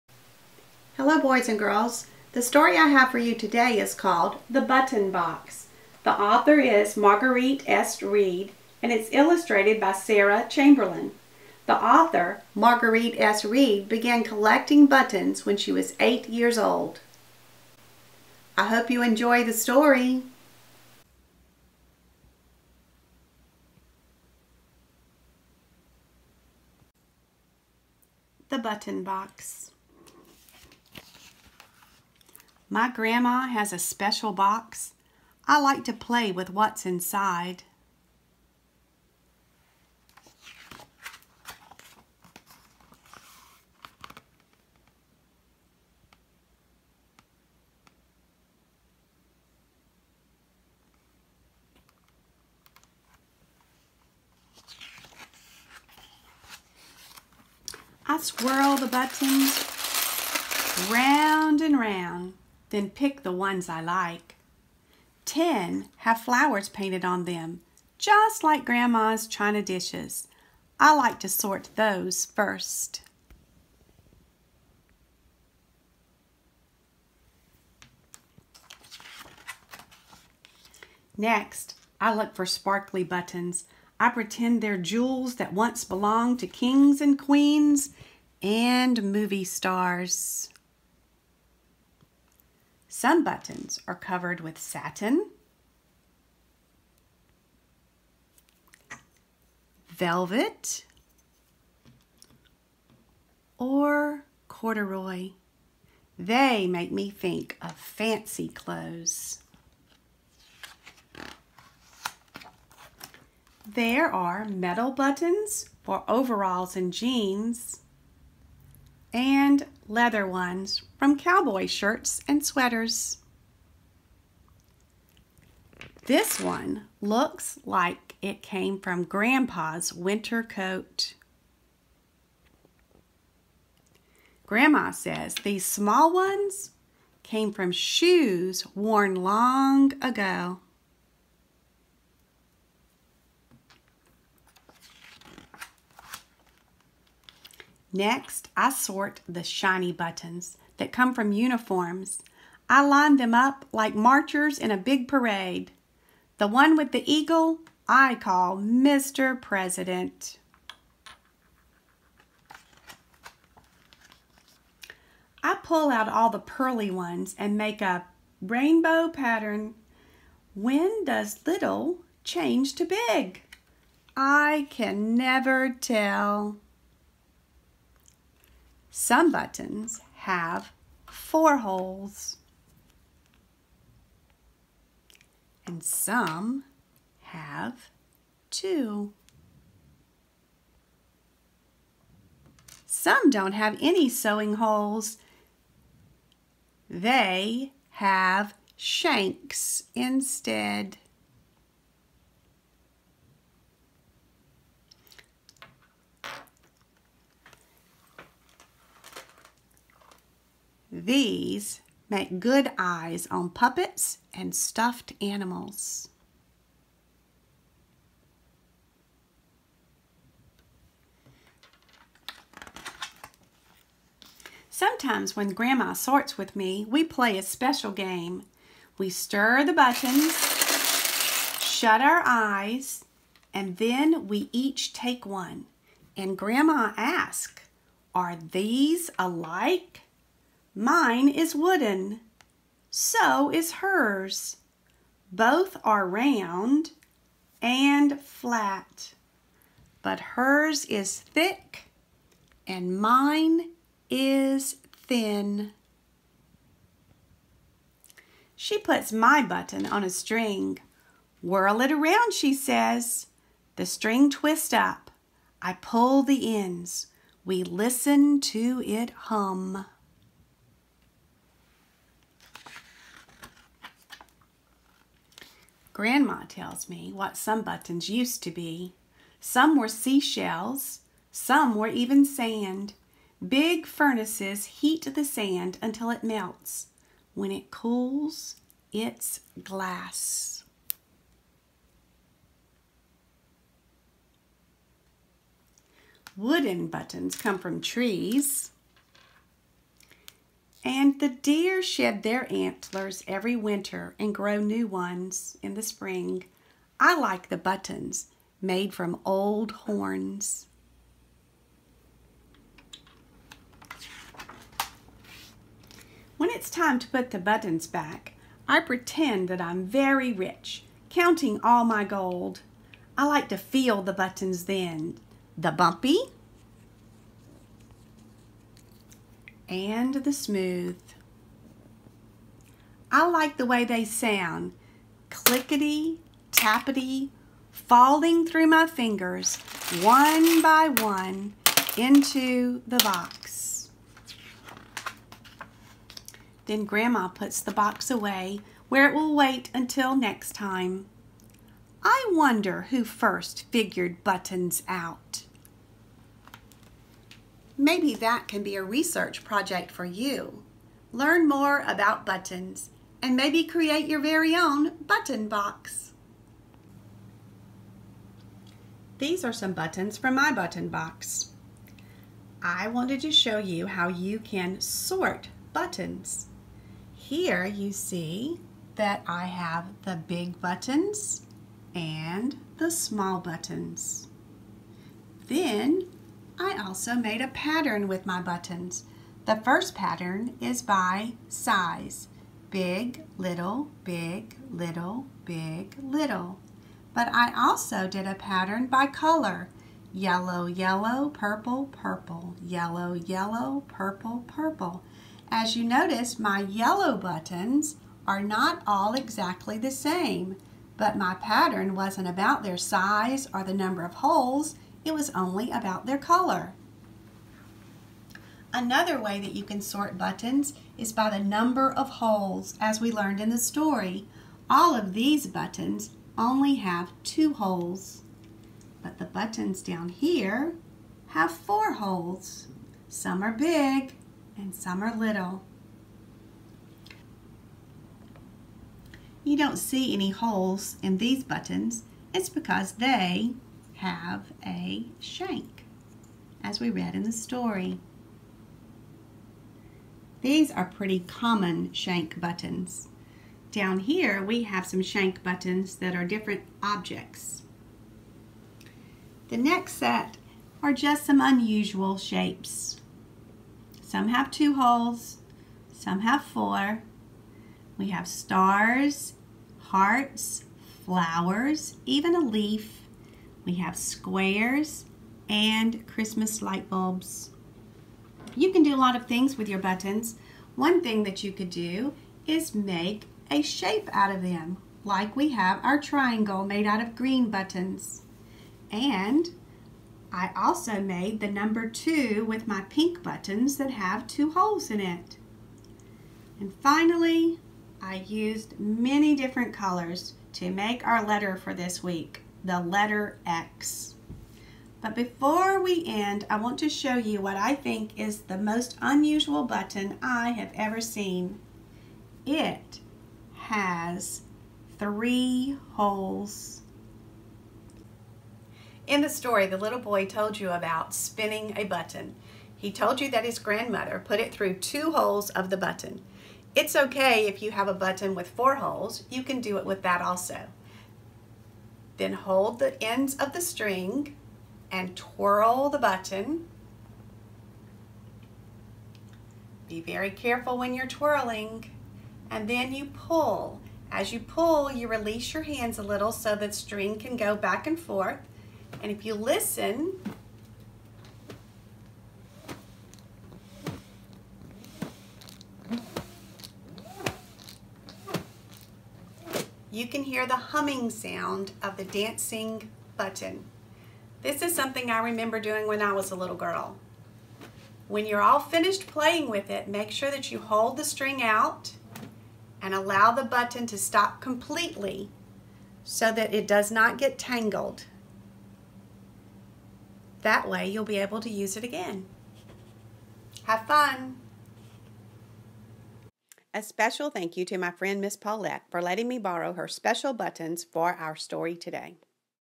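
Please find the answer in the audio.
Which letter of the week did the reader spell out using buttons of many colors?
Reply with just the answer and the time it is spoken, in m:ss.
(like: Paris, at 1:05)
X, at 8:23.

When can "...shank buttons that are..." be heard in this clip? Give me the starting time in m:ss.
7:35.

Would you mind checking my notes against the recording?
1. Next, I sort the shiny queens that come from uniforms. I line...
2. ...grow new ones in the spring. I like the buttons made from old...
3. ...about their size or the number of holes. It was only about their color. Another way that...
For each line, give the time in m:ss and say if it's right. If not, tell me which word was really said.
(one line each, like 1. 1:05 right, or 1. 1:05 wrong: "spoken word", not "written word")
1. 2:27 wrong: "buttons", not "queens"
2. 5:04 right
3. 6:52 right.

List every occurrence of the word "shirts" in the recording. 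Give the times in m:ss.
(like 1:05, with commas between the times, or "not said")
2:01.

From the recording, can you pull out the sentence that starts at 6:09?
These are some buttons from my button box.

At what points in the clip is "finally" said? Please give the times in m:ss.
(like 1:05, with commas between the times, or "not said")
8:16.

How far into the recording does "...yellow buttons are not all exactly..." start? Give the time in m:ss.
6:46.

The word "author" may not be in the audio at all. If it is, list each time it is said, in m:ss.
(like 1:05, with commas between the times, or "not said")
0:06, 0:11.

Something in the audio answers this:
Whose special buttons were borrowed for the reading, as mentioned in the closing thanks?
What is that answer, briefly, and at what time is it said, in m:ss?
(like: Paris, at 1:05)
Miss Paulette, at 9:48.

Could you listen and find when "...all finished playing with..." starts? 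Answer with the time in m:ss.
9:28.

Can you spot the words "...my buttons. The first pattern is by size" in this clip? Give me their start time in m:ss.
6:28.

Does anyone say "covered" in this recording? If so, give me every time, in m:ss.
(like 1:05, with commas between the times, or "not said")
1:33.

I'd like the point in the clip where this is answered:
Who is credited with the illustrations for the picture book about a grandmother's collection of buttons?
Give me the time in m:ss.
0:09.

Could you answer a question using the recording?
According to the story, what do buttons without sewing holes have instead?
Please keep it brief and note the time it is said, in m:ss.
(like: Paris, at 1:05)
Shanks, at 3:18.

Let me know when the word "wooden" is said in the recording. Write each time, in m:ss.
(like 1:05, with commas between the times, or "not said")
4:01, 4:56.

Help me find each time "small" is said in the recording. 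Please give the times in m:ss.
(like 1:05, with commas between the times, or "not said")
2:15, 6:22.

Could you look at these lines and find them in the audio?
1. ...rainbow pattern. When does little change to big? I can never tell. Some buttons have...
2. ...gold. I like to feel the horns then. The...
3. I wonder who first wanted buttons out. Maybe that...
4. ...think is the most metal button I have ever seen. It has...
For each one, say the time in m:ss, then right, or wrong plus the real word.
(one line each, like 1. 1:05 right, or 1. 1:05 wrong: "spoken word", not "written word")
1. 2:48 right
2. 5:22 wrong: "buttons", not "horns"
3. 5:52 wrong: "figured", not "wanted"
4. 8:27 wrong: "unusual", not "metal".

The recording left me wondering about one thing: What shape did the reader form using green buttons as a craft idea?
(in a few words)
Triangle.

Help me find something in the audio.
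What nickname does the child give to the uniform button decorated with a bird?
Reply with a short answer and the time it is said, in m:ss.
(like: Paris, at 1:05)
Mr. President, at 2:38.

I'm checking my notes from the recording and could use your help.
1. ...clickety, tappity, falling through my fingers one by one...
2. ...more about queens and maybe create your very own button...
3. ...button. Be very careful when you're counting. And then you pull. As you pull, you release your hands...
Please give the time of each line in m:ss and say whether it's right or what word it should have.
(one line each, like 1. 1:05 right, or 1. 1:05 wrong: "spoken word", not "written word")
1. 5:35 right
2. 6:01 wrong: "buttons", not "queens"
3. 8:55 wrong: "twirling", not "counting".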